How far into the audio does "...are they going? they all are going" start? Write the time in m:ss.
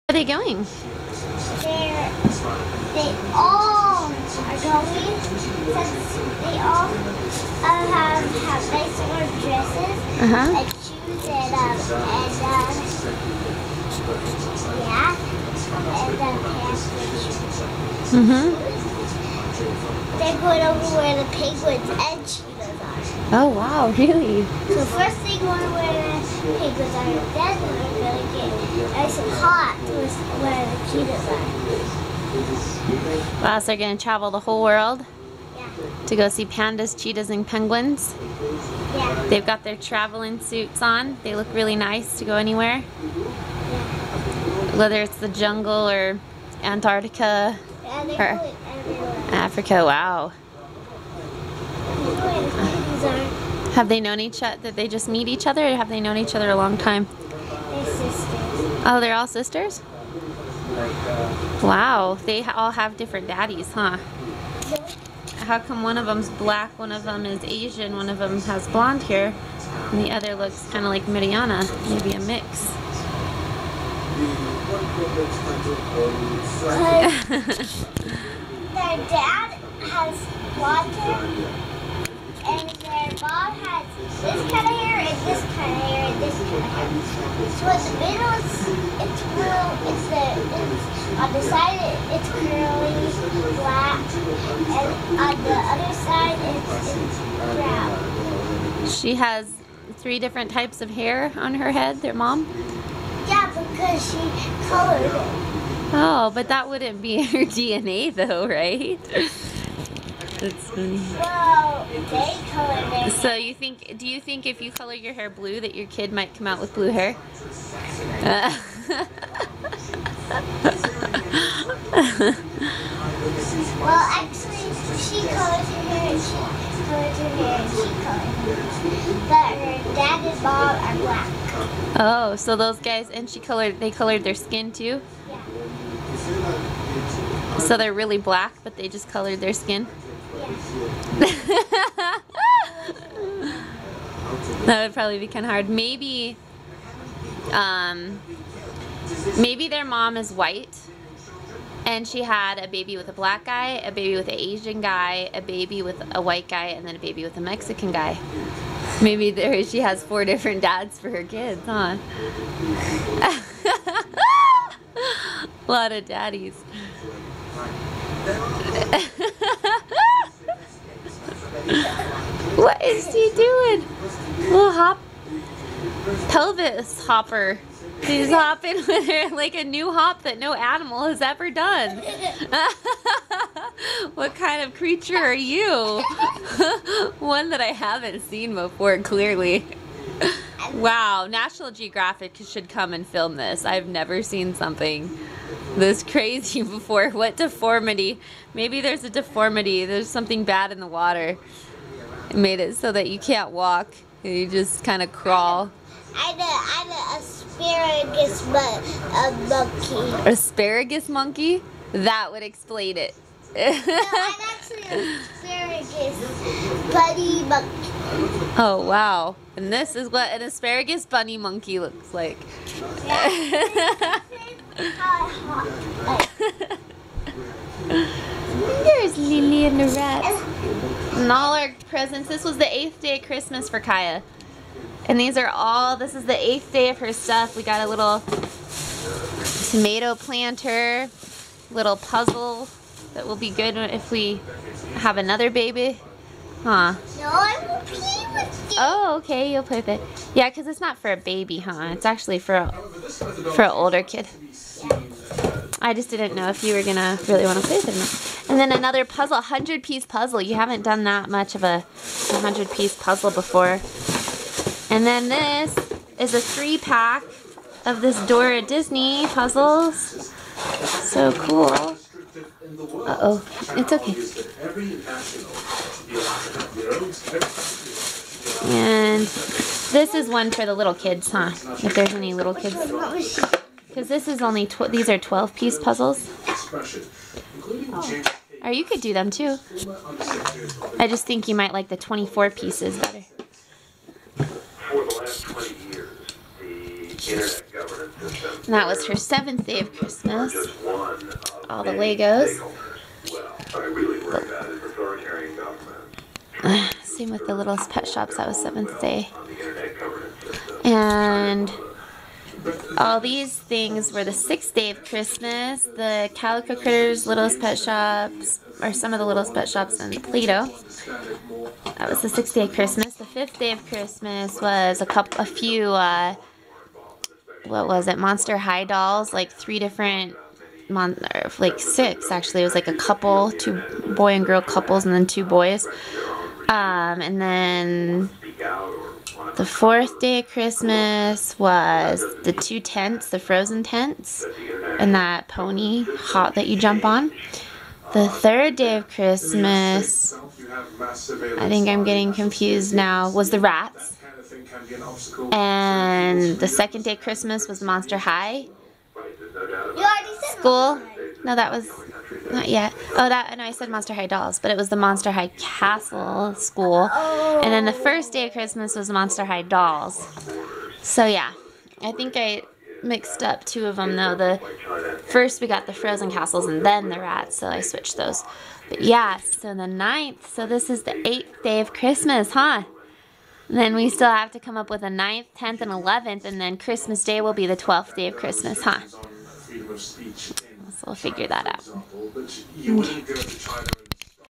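0:00.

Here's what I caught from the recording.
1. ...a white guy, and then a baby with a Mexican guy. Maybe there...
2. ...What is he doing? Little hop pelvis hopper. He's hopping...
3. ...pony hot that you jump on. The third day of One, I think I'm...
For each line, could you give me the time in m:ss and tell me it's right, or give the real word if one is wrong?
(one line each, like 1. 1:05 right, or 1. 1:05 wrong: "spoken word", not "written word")
1. 2:36 right
2. 2:52 right
3. 5:45 wrong: "Christmas", not "One".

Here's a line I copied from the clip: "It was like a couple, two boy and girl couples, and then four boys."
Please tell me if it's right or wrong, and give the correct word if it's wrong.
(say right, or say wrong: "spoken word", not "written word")
wrong: "two", not "four".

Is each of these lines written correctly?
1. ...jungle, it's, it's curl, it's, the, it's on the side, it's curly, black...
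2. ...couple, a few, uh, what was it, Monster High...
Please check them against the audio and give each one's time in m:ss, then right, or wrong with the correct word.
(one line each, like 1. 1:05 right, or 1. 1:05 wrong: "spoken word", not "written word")
1. 1:28 wrong: "middle", not "jungle"
2. 5:25 right.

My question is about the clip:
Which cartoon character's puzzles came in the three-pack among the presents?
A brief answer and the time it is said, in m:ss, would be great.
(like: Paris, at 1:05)
Dora, at 4:28.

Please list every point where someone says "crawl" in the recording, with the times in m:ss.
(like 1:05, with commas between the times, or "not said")
3:25.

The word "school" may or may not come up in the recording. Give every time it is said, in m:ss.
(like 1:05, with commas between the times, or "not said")
6:00, 6:06.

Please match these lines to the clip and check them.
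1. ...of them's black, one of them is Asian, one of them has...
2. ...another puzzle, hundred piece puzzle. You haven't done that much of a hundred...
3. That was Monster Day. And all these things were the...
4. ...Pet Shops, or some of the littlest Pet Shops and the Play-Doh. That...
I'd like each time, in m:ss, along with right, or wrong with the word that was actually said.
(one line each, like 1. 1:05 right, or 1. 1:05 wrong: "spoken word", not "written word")
1. 1:05 right
2. 4:18 right
3. 5:08 wrong: "Seventh", not "Monster"
4. 5:17 right.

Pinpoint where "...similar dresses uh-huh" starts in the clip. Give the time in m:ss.
0:08.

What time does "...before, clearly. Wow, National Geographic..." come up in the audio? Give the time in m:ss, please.
3:08.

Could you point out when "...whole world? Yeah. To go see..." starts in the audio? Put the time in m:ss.
0:34.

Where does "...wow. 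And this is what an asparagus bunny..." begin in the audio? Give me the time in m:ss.
3:38.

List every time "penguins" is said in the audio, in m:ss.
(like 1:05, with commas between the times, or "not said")
0:21, 0:37.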